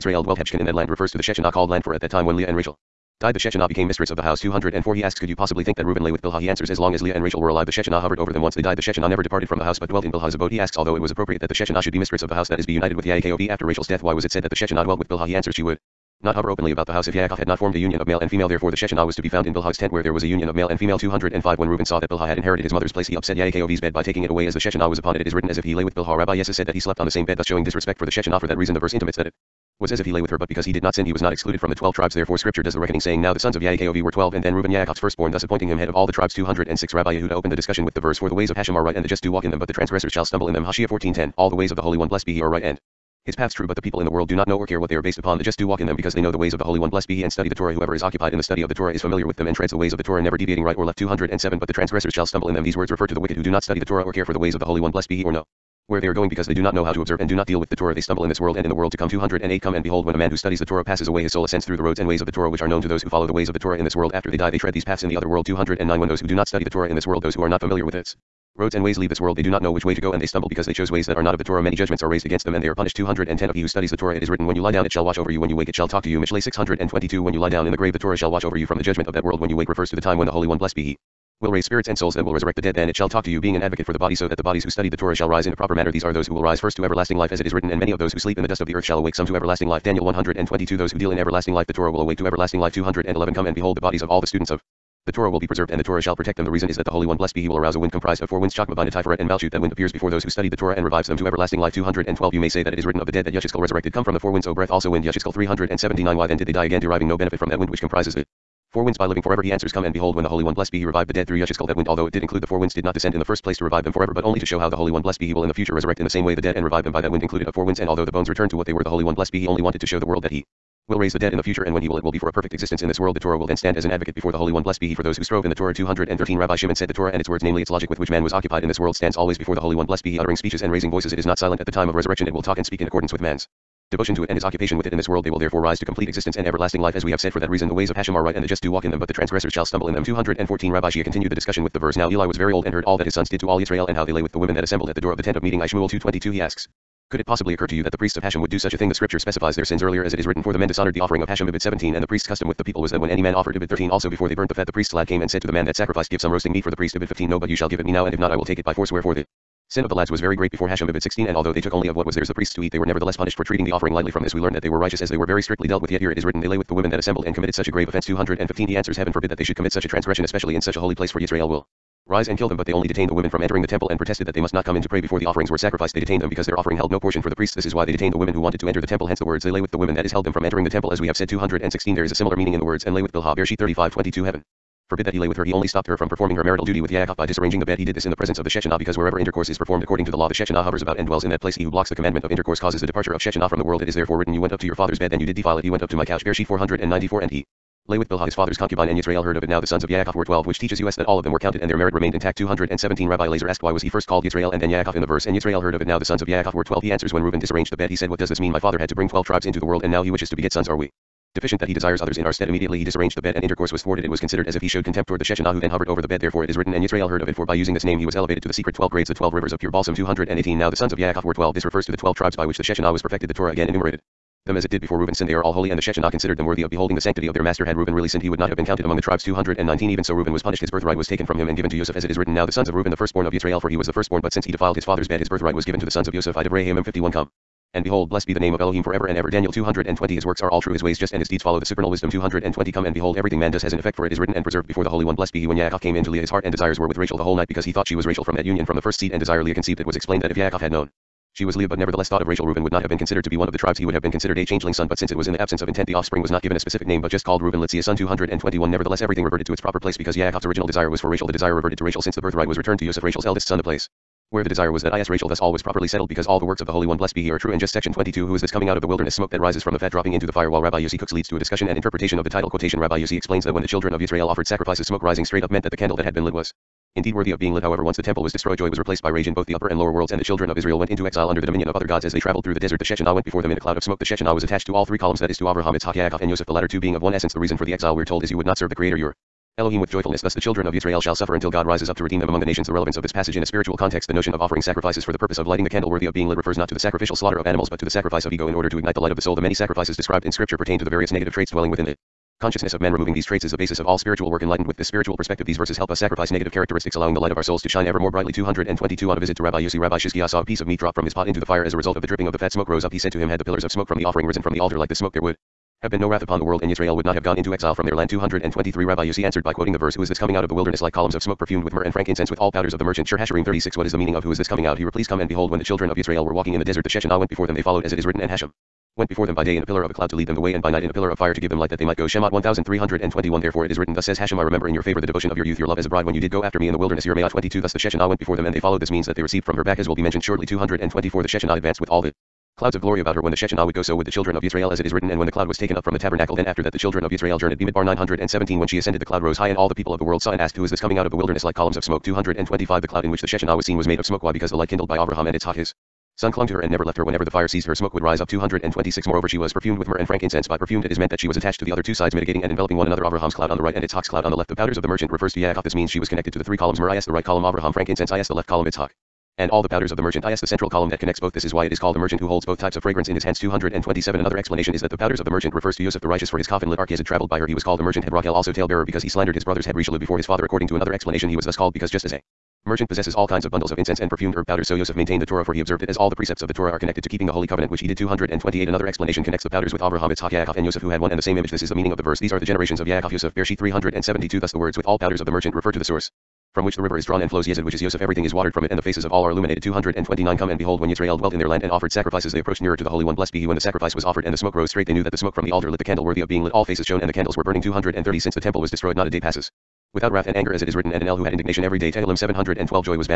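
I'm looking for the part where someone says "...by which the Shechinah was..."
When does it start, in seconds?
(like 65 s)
222 s.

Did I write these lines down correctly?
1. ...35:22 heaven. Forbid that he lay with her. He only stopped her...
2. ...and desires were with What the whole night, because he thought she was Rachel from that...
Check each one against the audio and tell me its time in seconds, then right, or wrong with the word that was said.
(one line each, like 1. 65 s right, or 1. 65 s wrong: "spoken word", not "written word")
1. 183 s right
2. 246 s wrong: "Rachel", not "What".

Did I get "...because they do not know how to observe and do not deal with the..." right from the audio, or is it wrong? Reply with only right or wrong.
right.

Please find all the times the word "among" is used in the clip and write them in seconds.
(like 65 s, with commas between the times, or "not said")
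228 s, 292 s.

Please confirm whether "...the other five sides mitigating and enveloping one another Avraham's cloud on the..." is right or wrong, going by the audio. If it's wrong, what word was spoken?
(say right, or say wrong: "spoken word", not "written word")
wrong: "two", not "five".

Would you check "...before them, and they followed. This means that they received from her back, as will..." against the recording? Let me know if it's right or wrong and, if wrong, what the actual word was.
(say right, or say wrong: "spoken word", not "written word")
right.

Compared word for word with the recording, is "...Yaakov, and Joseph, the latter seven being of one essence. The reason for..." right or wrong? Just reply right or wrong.
wrong.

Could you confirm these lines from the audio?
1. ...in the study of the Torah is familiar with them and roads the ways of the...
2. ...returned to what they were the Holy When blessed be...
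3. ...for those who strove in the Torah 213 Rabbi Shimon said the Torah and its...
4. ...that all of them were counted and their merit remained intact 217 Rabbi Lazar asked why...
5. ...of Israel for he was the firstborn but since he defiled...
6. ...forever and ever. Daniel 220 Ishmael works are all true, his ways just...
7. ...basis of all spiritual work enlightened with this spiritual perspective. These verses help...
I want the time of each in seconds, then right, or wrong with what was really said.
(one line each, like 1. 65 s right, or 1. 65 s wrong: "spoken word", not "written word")
1. 48 s wrong: "treads", not "roads"
2. 118 s wrong: "One", not "When"
3. 124 s right
4. 200 s right
5. 233 s right
6. 238 s wrong: "His", not "Ishmael"
7. 303 s right.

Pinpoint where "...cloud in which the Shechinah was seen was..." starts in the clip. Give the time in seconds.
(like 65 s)
352 s.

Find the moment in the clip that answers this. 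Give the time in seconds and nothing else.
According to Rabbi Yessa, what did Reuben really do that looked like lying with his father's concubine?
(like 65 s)
26 s.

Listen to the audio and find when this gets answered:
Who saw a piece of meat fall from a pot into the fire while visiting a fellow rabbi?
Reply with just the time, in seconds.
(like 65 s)
309 s.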